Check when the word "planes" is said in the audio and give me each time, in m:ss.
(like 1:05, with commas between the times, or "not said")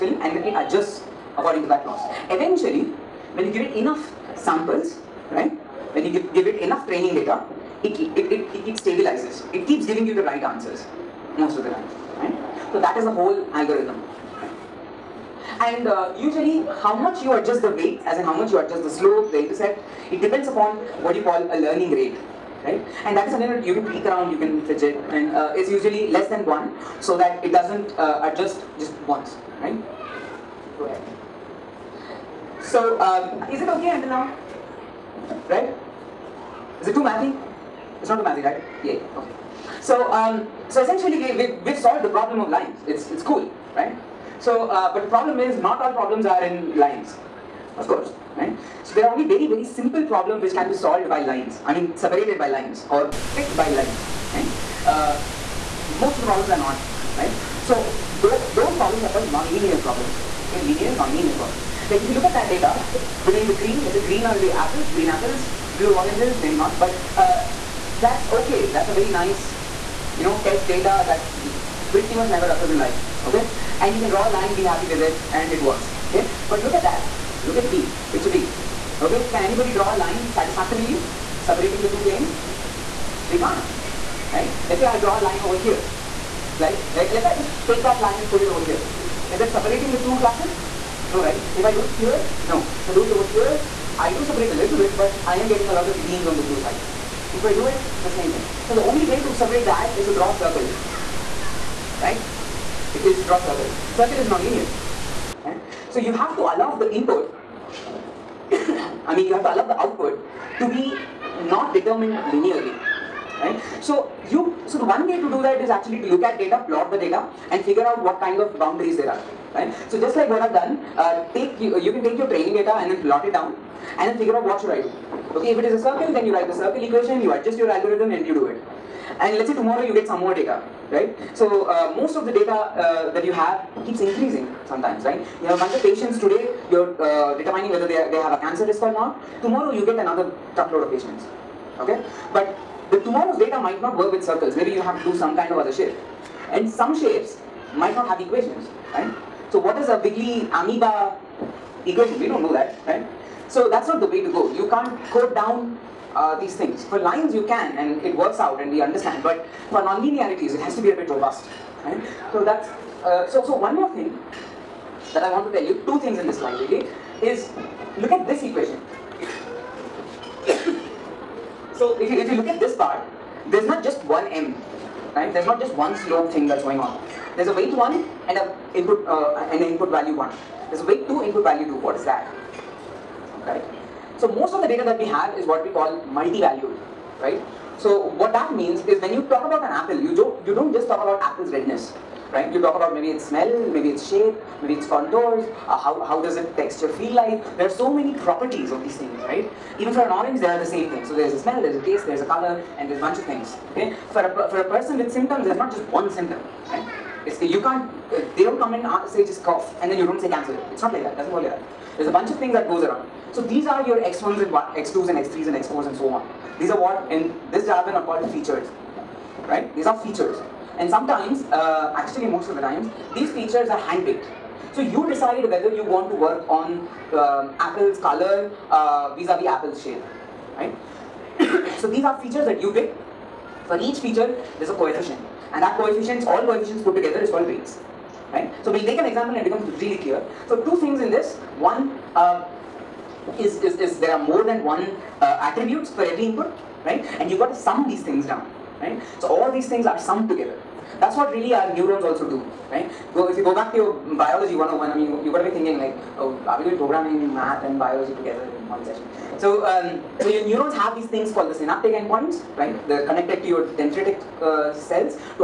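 1:22.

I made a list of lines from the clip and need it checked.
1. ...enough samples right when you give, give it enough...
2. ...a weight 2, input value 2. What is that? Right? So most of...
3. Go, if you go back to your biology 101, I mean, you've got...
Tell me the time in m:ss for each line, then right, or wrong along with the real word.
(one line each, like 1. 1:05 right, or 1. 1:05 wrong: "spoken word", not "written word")
1. 0:03 right
2. 3:00 right
3. 4:13 right.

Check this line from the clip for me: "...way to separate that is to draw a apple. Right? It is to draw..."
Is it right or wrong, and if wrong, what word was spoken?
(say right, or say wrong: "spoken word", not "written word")
wrong: "circle", not "apple".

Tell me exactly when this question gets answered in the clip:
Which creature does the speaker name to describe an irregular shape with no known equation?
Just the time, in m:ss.
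2:30.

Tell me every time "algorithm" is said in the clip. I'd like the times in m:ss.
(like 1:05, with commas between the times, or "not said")
0:13, 2:07.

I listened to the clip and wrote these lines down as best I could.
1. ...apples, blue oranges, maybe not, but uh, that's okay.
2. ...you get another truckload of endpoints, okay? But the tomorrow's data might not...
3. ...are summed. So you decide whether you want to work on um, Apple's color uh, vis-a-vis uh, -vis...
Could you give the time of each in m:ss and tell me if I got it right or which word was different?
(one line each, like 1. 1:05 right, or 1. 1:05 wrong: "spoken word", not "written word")
1. 1:05 right
2. 2:19 wrong: "patients", not "endpoints"
3. 3:43 wrong: "handpicked", not "summed".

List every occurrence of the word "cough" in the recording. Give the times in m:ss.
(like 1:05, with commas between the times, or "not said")
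3:29.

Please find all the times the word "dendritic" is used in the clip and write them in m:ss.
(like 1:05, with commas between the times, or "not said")
4:23.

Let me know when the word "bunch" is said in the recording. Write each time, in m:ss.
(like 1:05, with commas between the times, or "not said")
2:15, 3:23, 3:32.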